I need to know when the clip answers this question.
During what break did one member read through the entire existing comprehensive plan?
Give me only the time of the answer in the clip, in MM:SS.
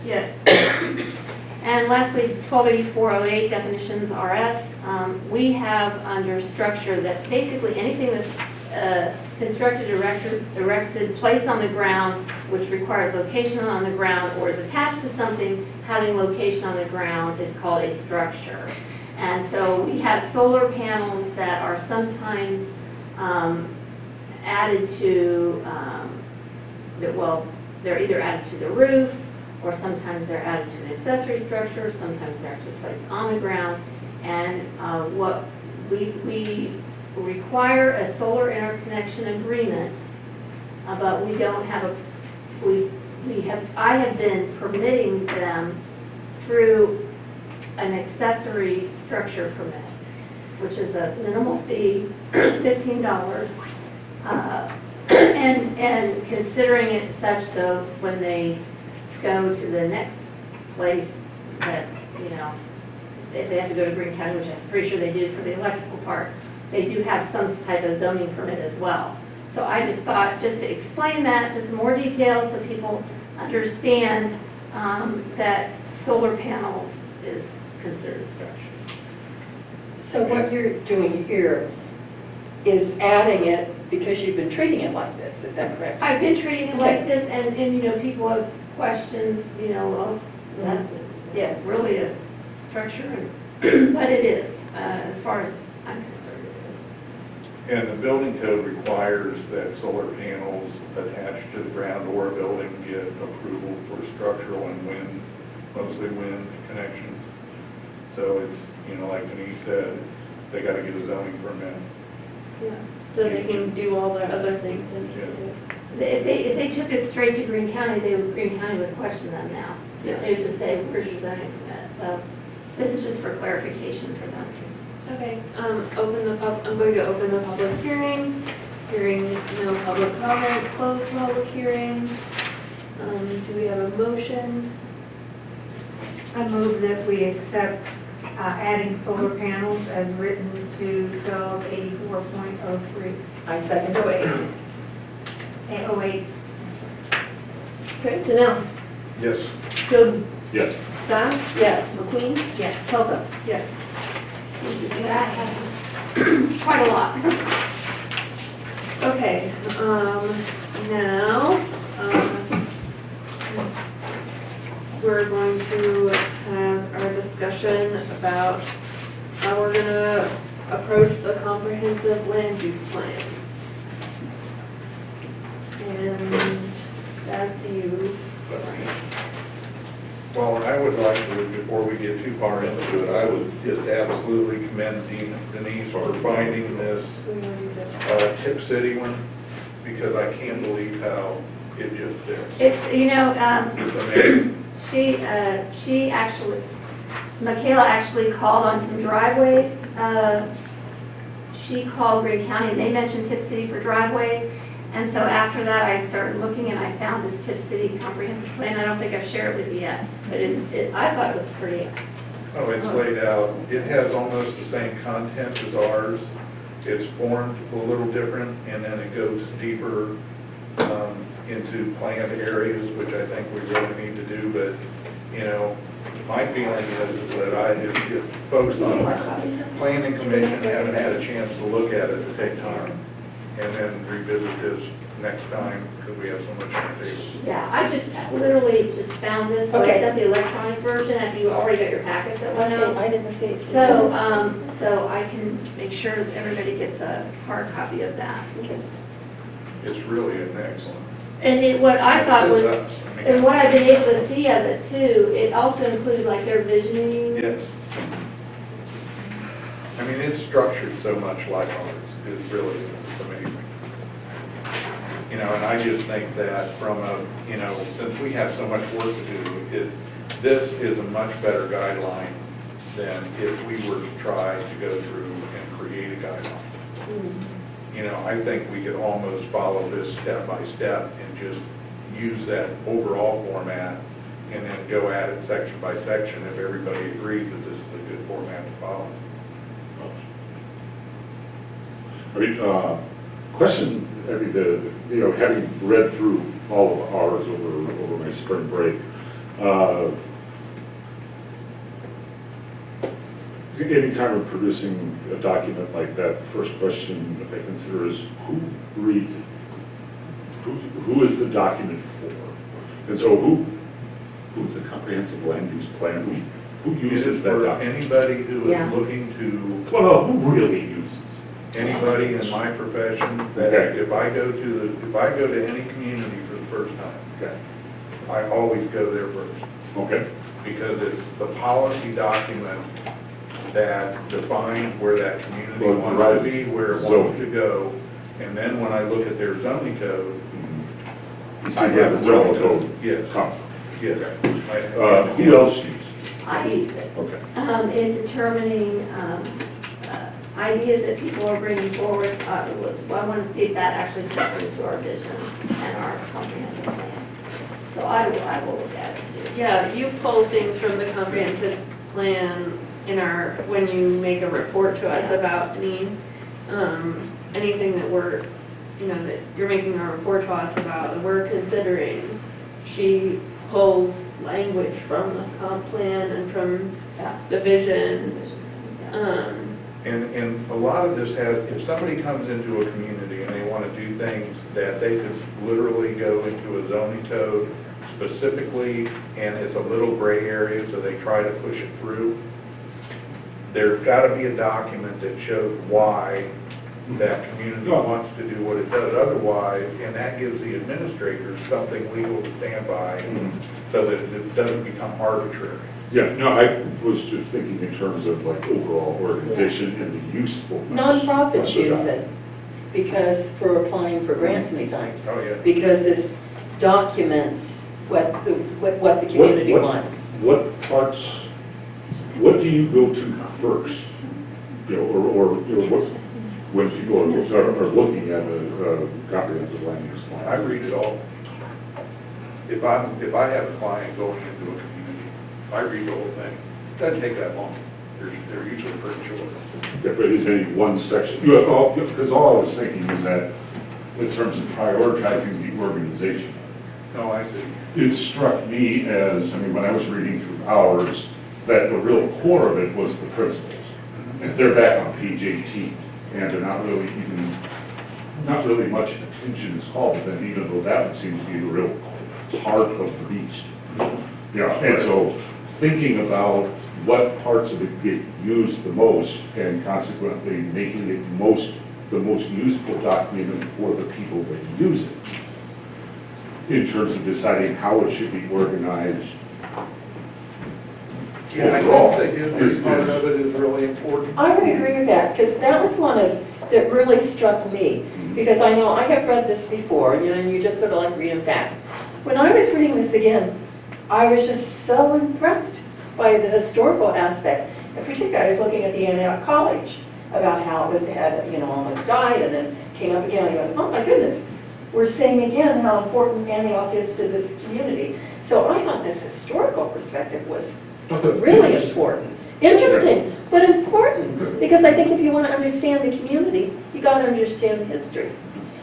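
04:58.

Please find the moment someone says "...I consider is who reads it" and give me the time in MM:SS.
05:07.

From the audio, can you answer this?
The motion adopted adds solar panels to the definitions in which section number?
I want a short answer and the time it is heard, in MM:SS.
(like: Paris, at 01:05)
84.03, at 02:21.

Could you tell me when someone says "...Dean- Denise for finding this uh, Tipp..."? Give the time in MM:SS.
03:05.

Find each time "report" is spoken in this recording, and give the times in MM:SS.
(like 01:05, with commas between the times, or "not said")
06:04, 06:10.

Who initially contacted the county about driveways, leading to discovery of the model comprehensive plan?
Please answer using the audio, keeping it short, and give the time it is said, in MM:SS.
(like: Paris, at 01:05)
Michaela, at 03:17.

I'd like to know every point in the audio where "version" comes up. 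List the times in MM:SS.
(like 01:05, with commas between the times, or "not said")
04:00.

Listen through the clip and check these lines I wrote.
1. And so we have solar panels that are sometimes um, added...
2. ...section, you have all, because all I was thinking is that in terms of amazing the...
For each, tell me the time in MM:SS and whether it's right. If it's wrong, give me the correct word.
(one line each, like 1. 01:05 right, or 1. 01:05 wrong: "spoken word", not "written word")
1. 00:19 right
2. 07:20 wrong: "prioritizing", not "amazing".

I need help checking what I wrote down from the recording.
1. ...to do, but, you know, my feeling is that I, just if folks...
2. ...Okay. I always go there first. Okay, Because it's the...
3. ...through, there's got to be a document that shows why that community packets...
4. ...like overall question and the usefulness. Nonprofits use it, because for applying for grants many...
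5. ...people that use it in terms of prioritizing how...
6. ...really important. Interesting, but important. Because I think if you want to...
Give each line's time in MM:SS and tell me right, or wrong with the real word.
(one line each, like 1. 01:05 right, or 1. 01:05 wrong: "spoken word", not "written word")
1. 03:44 right
2. 05:27 right
3. 06:31 wrong: "wants", not "packets"
4. 06:48 wrong: "organization", not "question"
5. 07:54 wrong: "deciding", not "prioritizing"
6. 08:31 right.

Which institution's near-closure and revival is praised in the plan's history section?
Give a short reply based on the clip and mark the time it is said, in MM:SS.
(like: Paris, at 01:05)
Antioch College, at 08:19.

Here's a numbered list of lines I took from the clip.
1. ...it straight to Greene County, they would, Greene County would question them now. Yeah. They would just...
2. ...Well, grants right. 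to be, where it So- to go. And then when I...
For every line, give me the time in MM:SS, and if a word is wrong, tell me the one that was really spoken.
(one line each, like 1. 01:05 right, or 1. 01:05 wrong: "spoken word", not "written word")
1. 01:56 right
2. 05:35 wrong: "wants", not "grants".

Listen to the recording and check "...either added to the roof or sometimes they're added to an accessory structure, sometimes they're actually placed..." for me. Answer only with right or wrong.
right.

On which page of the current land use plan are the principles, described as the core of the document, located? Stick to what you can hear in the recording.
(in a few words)
18.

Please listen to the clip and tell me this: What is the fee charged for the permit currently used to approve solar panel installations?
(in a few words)
$15.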